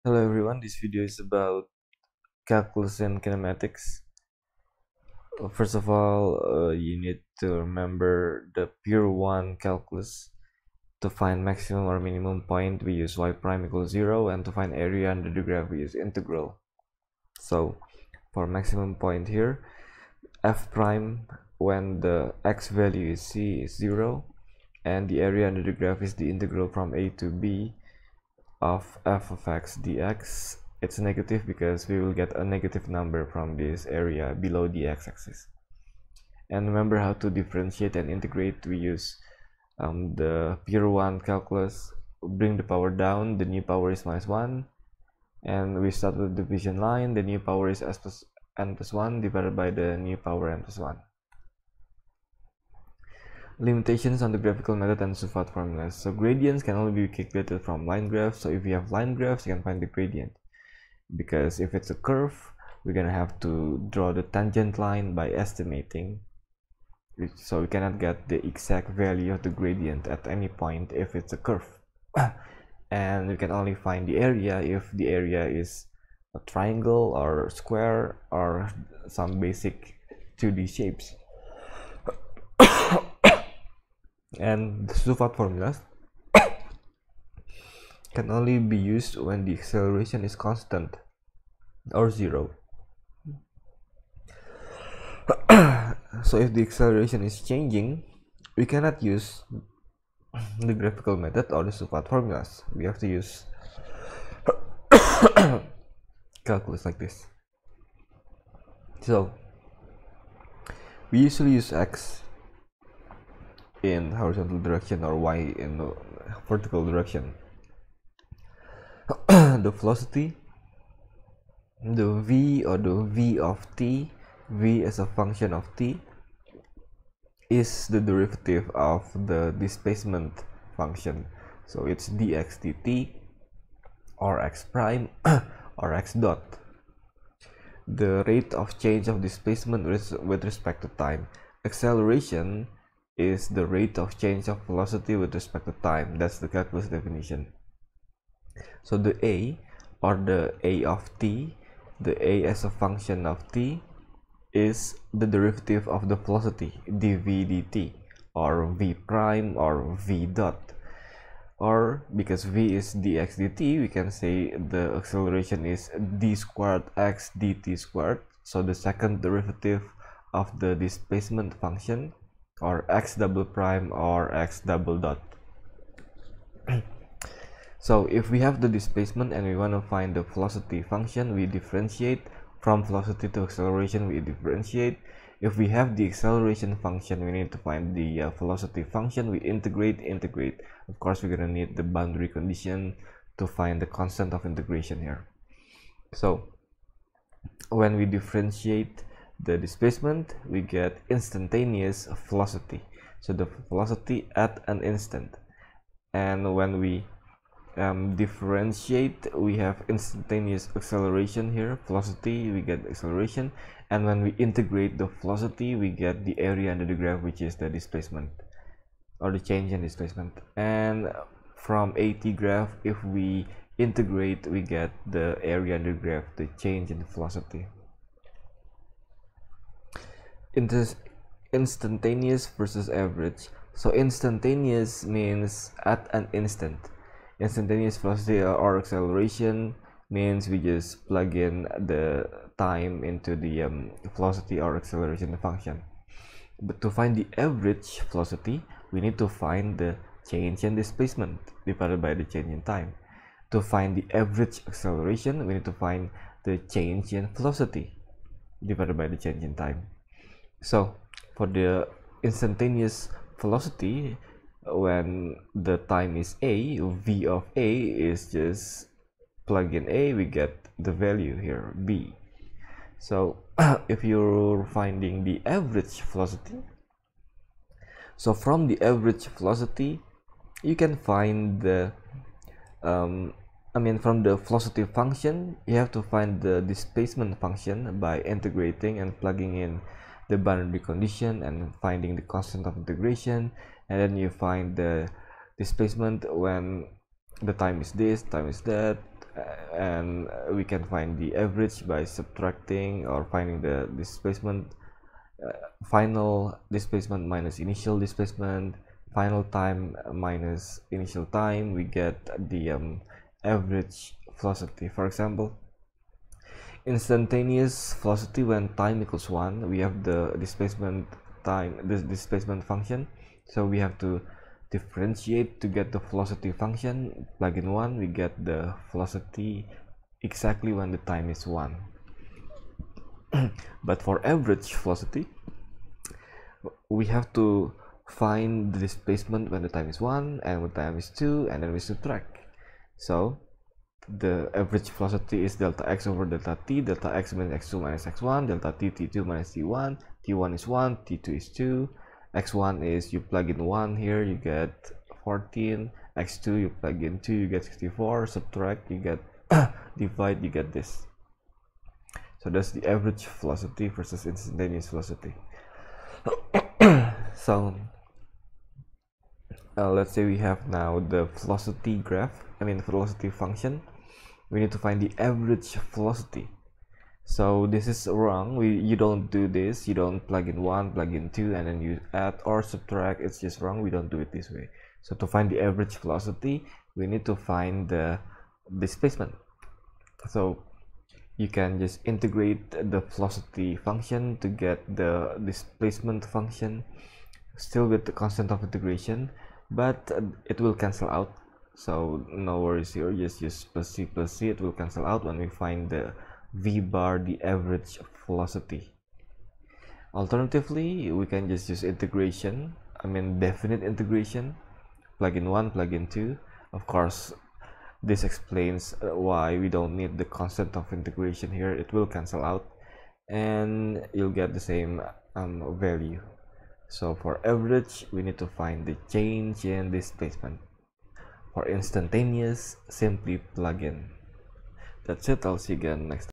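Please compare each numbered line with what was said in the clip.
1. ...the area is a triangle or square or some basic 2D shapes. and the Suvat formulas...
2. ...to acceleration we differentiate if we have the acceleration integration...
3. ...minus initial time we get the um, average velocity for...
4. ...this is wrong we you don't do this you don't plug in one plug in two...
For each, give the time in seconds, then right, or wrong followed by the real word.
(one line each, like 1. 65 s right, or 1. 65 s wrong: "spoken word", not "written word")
1. 74 s right
2. 183 s wrong: "function", not "integration"
3. 310 s right
4. 377 s right.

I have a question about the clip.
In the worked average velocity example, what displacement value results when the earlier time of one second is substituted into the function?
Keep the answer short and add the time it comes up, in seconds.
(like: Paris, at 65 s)
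14, at 355 s.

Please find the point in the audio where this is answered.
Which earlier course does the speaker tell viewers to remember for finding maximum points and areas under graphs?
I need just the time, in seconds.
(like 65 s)
8 s.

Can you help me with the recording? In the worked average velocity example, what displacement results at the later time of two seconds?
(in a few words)
64.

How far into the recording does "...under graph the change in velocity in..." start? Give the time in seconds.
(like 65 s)
225 s.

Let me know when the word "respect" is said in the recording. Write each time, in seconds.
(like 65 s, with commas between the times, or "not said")
140 s, 145 s.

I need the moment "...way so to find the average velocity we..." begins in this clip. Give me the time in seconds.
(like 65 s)
384 s.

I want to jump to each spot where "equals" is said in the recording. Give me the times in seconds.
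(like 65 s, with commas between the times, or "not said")
13 s, 319 s.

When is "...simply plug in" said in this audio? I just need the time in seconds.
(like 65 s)
432 s.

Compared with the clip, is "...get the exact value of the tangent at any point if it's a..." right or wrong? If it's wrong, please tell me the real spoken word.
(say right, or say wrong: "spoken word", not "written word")
wrong: "gradient", not "tangent".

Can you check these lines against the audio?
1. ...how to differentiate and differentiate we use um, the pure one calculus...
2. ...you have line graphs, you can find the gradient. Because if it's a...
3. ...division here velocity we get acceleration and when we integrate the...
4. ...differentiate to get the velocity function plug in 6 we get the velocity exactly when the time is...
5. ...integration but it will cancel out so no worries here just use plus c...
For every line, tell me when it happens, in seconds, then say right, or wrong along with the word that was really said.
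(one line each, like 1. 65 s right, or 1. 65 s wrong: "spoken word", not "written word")
1. 36 s wrong: "integrate", not "differentiate"
2. 58 s right
3. 210 s wrong: "acceleration", not "division"
4. 324 s wrong: "1", not "6"
5. 398 s right.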